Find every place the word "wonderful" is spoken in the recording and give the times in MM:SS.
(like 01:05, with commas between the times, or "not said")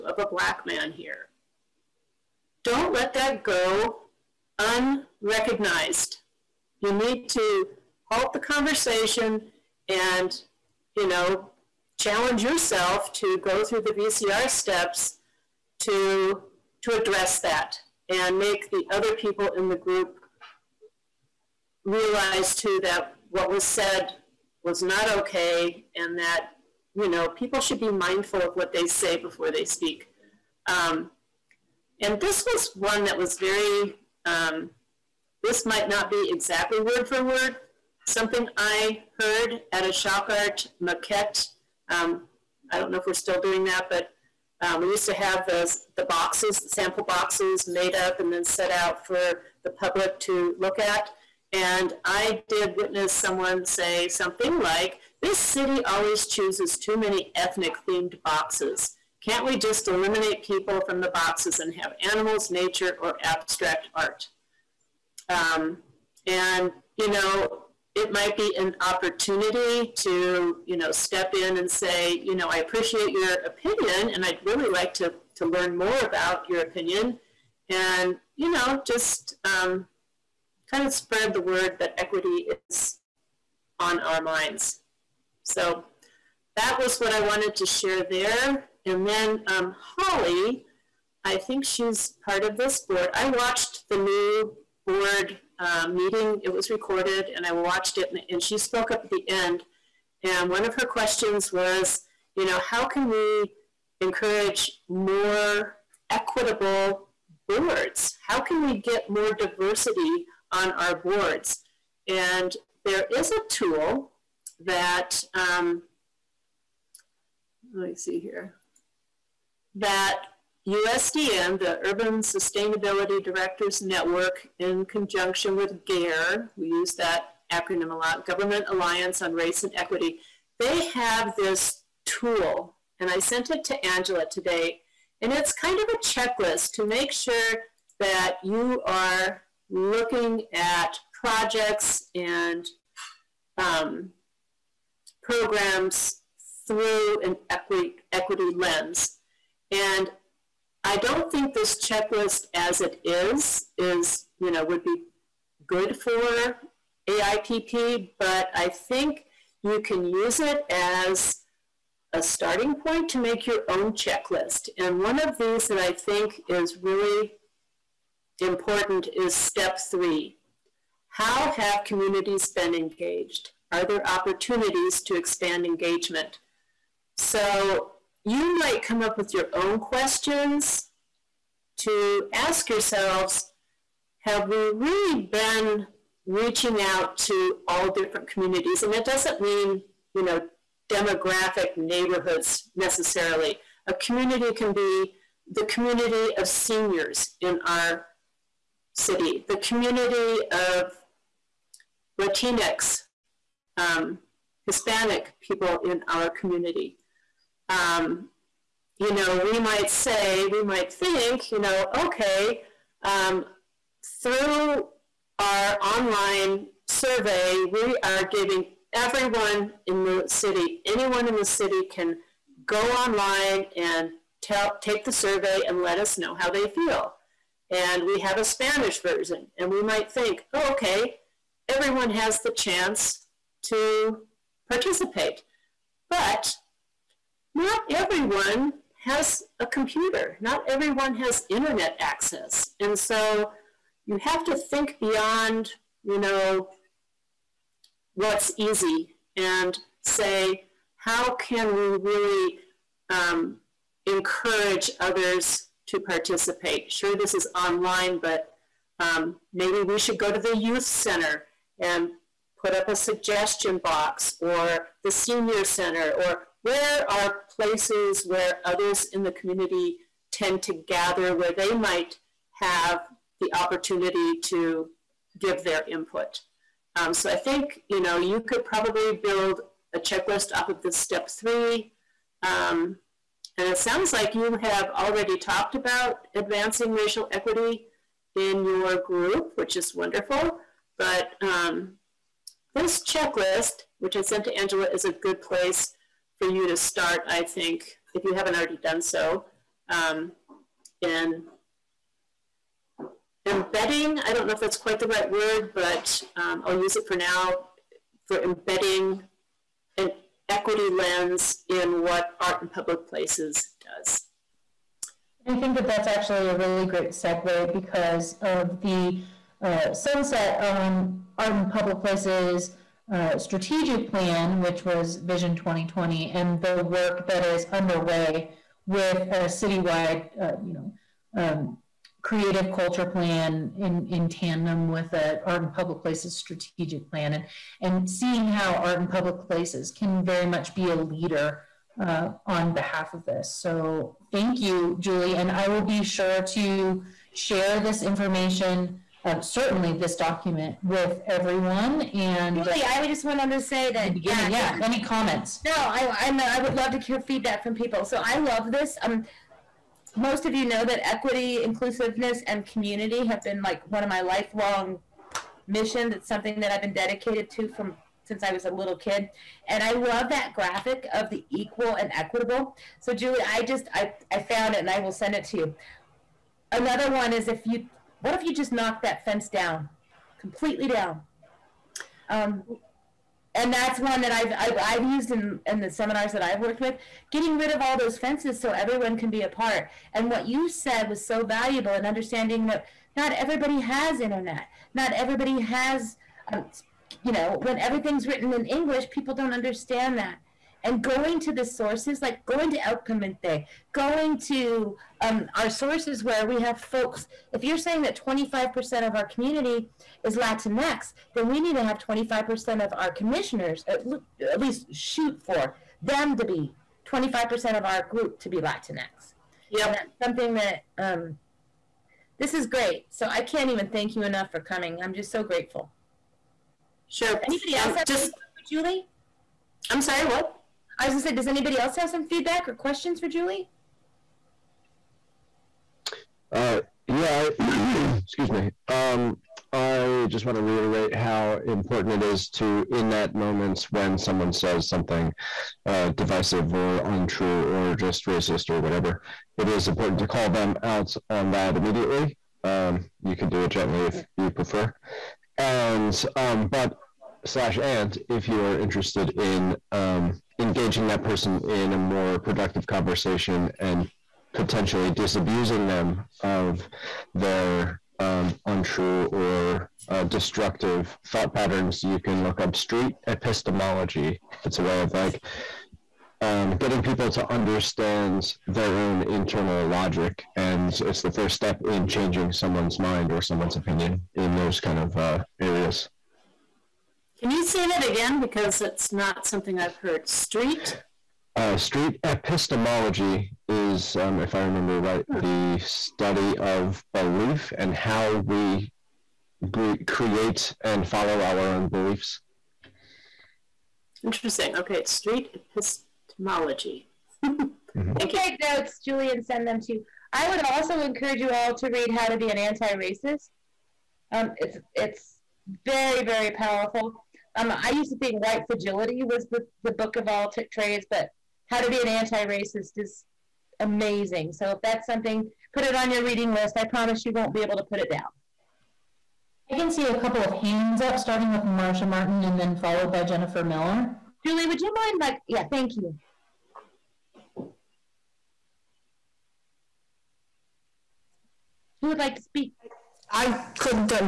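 04:49.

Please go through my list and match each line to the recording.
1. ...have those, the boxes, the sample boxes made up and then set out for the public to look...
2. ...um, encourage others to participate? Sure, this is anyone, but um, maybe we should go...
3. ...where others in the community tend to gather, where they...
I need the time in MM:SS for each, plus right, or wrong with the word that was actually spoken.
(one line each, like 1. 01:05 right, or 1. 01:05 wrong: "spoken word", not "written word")
1. 00:45 right
2. 04:13 wrong: "online", not "anyone"
3. 04:28 right.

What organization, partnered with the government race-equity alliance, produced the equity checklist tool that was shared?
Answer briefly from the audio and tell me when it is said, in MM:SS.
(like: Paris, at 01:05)
Urban Sustainability Directors Network, at 02:01.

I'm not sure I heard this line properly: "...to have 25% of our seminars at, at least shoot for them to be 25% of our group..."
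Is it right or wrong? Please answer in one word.
wrong.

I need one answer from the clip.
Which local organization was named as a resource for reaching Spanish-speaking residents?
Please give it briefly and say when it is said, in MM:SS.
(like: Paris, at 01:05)
el Comité, at 06:42.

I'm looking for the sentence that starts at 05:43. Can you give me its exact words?
So thank you, Julie, and I will be sure to share this information um, certainly this document with everyone.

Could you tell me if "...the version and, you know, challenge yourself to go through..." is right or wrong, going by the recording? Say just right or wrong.
wrong.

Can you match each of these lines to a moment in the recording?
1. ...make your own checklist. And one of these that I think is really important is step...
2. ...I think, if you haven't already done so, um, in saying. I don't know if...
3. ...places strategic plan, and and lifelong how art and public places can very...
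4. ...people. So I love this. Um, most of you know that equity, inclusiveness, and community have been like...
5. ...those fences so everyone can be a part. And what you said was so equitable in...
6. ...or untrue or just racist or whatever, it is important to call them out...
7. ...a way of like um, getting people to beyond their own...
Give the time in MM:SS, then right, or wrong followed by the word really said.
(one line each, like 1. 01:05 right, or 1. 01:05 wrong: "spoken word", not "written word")
1. 02:43 right
2. 04:57 wrong: "embedding", not "saying"
3. 05:36 wrong: "seeing", not "lifelong"
4. 05:57 right
5. 06:27 wrong: "valuable", not "equitable"
6. 07:26 right
7. 07:54 wrong: "understand", not "beyond".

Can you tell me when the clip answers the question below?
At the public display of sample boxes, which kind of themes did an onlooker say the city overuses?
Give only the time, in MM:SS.
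00:57.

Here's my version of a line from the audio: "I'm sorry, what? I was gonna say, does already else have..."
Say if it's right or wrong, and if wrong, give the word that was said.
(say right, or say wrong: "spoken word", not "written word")
wrong: "anybody", not "already".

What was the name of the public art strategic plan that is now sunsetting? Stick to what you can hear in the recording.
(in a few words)
Vision 2020.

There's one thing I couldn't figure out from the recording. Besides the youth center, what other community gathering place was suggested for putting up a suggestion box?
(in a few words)
senior center.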